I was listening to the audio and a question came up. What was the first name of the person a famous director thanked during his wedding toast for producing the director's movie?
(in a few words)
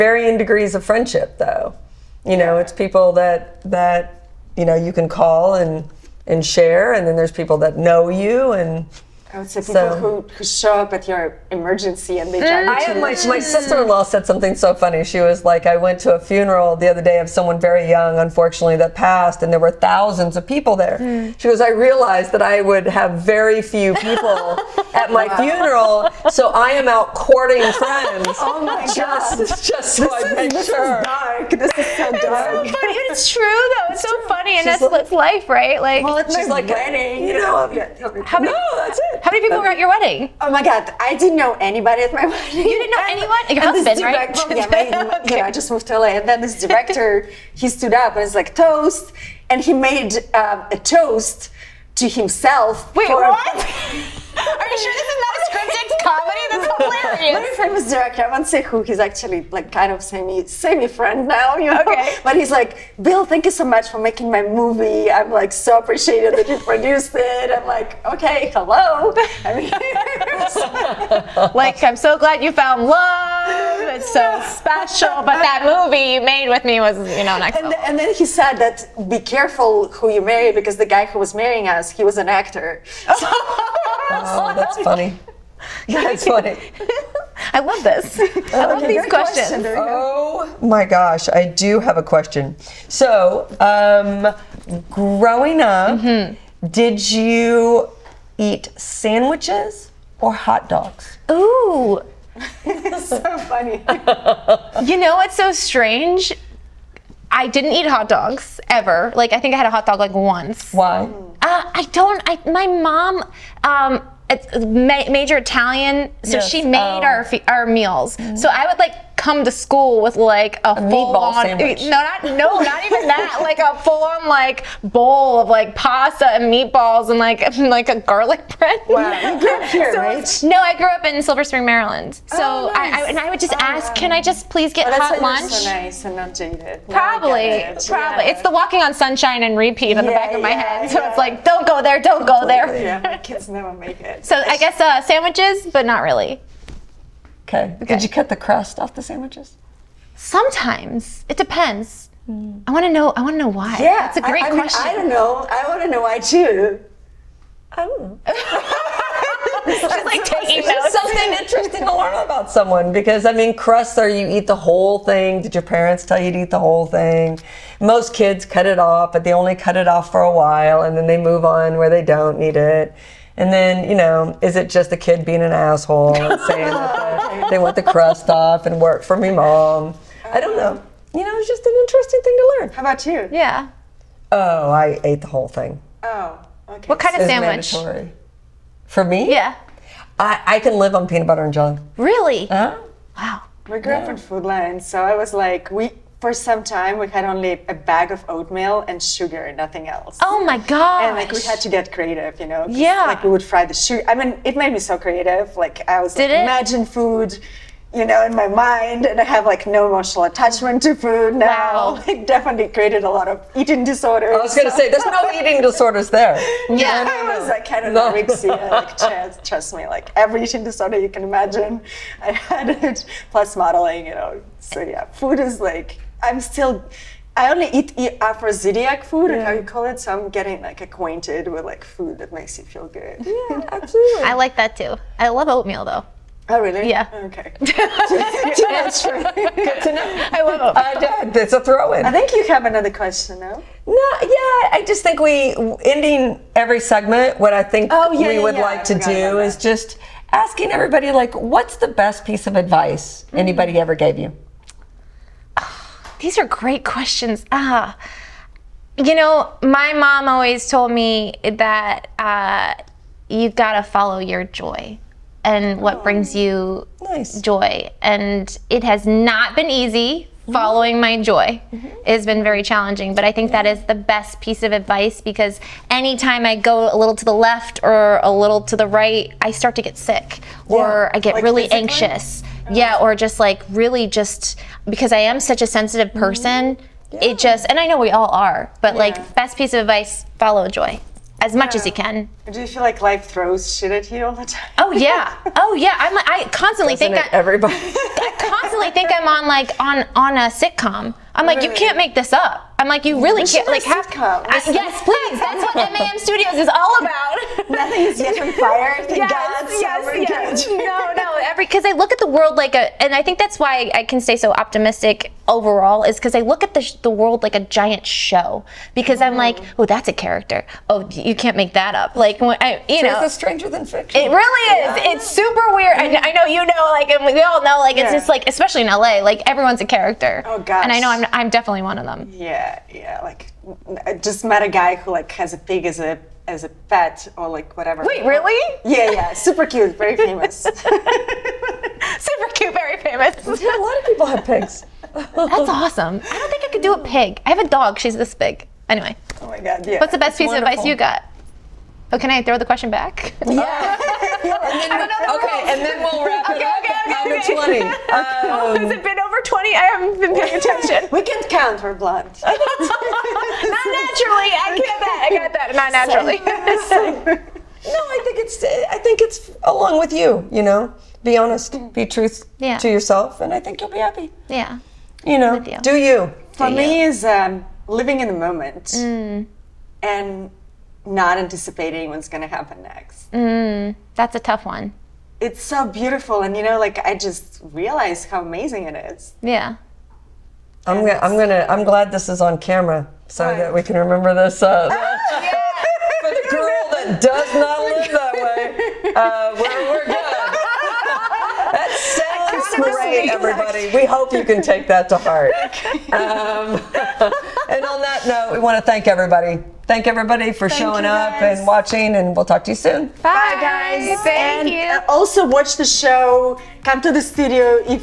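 Bill.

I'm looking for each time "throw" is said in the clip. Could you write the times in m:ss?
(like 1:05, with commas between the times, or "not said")
4:01, 4:53, 5:52.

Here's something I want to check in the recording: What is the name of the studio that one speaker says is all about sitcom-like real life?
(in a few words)
MAM Studios.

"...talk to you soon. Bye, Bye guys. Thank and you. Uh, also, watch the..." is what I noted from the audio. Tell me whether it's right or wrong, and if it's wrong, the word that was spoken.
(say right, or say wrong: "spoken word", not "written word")
right.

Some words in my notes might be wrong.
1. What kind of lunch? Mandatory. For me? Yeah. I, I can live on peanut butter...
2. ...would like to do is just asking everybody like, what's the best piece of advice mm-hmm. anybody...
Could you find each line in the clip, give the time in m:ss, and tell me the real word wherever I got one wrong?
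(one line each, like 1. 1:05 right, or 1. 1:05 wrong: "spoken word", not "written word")
1. 3:06 wrong: "sandwich", not "lunch"
2. 4:08 right.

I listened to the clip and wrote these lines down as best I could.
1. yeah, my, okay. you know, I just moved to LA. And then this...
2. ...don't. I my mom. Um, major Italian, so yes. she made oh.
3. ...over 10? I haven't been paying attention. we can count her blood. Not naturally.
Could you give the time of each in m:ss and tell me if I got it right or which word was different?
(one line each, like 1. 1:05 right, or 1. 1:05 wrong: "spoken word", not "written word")
1. 0:44 right
2. 1:51 right
3. 5:59 wrong: "20", not "10".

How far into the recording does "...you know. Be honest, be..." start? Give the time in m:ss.
6:10.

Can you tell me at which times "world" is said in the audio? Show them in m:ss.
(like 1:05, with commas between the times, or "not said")
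5:12, 5:17.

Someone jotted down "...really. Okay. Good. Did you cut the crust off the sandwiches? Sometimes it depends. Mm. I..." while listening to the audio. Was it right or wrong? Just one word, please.
right.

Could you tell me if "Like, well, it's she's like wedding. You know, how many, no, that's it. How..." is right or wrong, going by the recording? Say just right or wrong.
right.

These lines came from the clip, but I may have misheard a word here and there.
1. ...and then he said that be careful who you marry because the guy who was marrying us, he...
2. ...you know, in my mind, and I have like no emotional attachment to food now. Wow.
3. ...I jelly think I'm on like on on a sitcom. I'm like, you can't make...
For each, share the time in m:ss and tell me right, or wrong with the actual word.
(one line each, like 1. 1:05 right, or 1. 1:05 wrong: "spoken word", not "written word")
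1. 1:17 right
2. 3:27 right
3. 4:57 wrong: "constantly", not "jelly".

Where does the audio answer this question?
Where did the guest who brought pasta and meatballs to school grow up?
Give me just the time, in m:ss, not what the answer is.
2:11.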